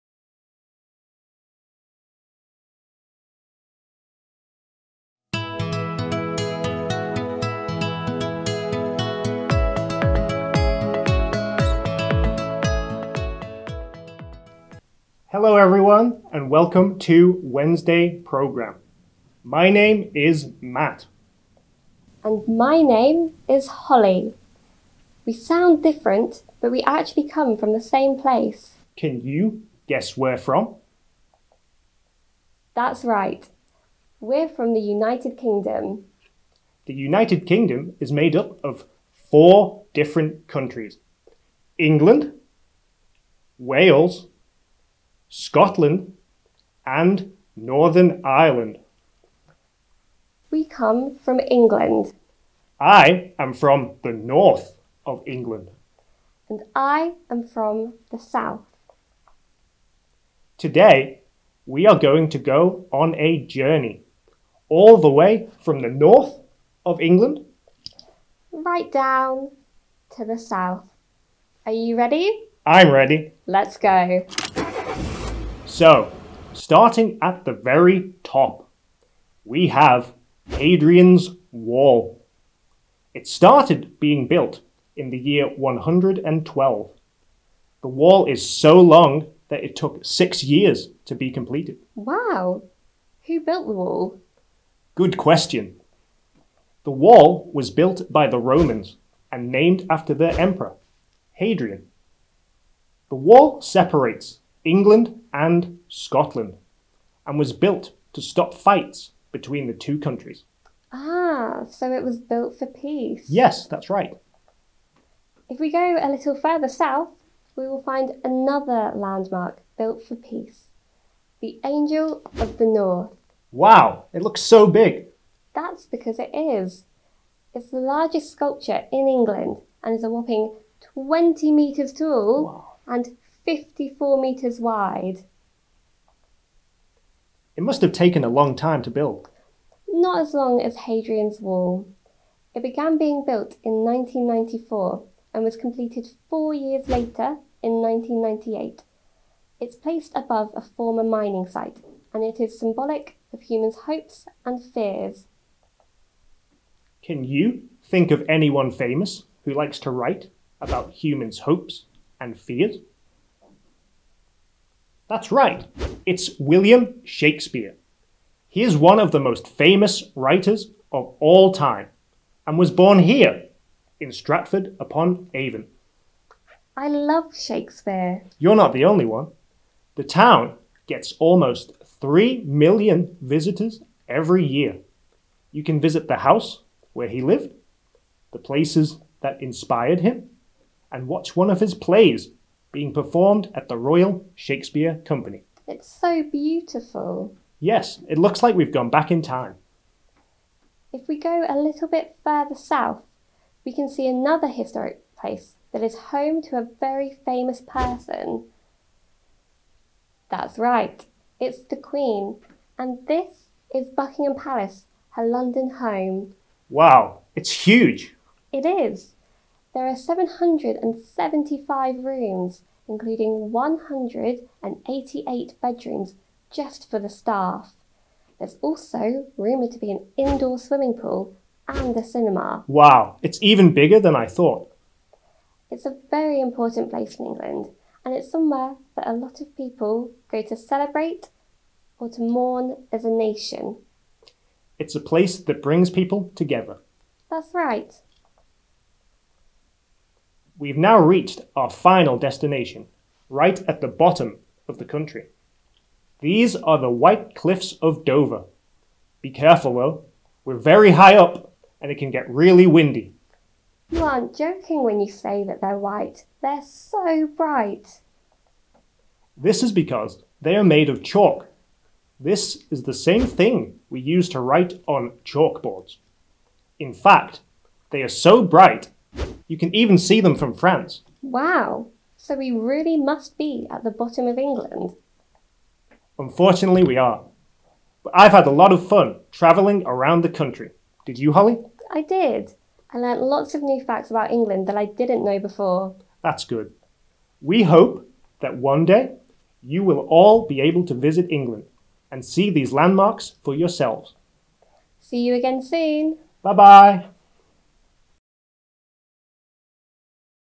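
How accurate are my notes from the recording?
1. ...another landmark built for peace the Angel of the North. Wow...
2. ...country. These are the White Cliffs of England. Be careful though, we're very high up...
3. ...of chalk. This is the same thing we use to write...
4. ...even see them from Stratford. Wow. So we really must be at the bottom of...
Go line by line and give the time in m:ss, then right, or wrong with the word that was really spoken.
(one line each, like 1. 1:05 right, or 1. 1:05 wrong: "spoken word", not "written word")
1. 1:58 right
2. 4:14 wrong: "Dover", not "England"
3. 4:30 right
4. 4:39 wrong: "France", not "Stratford".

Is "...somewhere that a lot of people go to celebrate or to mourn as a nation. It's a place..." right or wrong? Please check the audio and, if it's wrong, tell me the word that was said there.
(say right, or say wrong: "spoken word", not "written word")
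right.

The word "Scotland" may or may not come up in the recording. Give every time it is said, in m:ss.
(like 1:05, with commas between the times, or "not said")
0:45, 1:45.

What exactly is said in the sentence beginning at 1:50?
Ah, so it was built for peace.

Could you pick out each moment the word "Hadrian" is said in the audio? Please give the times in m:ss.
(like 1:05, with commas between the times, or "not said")
1:20, 1:41, 2:20.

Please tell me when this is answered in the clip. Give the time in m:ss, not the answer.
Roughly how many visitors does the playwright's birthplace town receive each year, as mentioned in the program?
3:01.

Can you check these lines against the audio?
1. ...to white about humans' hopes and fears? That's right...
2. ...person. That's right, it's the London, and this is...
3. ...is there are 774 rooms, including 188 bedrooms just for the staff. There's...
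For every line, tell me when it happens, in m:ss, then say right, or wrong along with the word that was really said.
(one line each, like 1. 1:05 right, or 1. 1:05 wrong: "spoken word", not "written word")
1. 2:39 wrong: "write", not "white"
2. 3:27 wrong: "Queen", not "London"
3. 3:38 wrong: "775", not "774".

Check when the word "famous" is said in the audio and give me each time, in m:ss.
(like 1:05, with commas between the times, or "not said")
2:38, 2:49, 3:27.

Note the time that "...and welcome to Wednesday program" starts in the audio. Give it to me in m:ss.
0:16.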